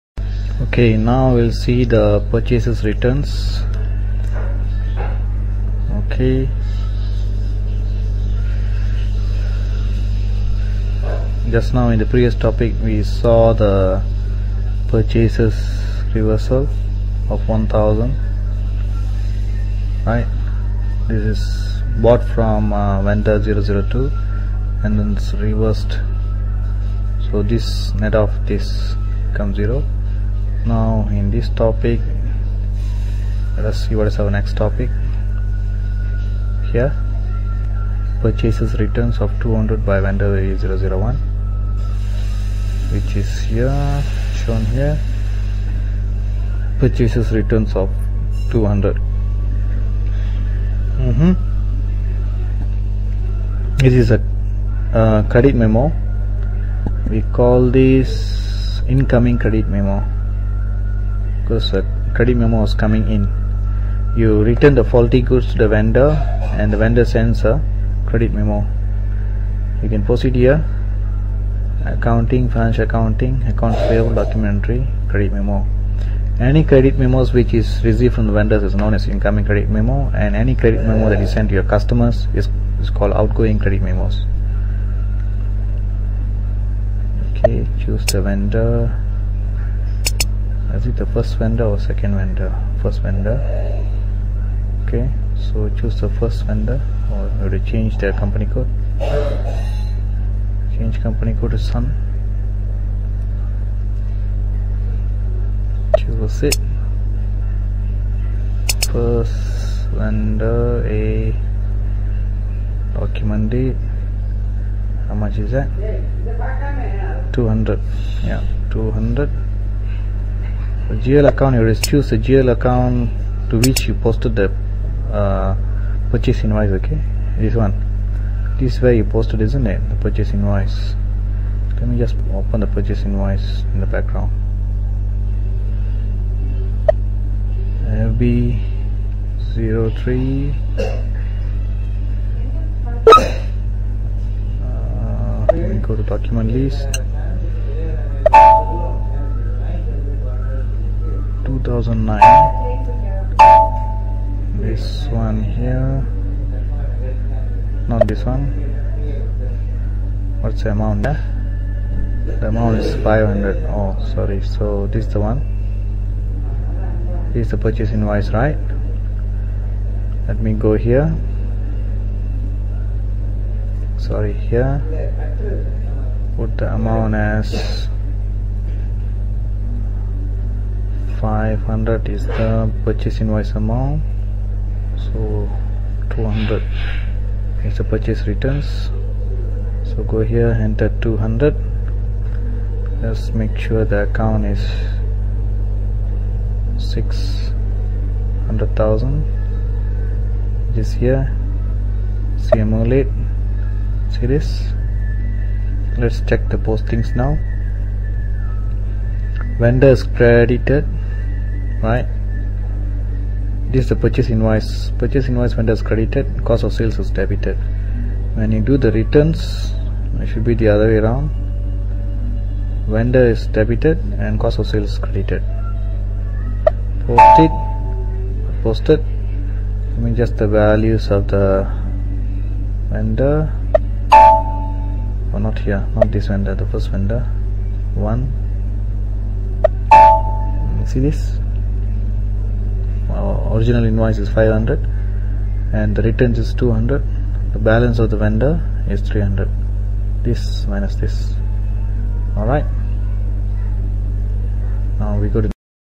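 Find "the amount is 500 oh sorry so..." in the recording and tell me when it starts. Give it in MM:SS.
02:42.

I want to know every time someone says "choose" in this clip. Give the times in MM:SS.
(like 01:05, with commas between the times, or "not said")
01:27, 01:35, 01:45, 02:01.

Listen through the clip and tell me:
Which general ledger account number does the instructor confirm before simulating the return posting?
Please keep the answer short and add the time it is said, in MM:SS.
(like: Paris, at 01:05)
600000, at 03:16.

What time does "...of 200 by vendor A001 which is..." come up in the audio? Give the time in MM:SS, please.
00:39.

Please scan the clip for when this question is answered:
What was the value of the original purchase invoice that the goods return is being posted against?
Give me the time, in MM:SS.
03:02.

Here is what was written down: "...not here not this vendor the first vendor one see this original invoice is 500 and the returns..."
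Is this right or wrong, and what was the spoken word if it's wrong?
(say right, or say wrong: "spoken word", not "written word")
right.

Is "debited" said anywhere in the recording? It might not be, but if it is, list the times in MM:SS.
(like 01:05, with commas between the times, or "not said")
03:37, 03:43.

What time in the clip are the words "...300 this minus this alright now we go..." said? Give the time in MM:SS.
04:09.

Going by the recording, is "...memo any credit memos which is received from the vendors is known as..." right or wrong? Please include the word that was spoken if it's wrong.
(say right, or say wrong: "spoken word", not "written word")
right.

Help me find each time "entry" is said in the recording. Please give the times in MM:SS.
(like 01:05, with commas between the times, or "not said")
01:14.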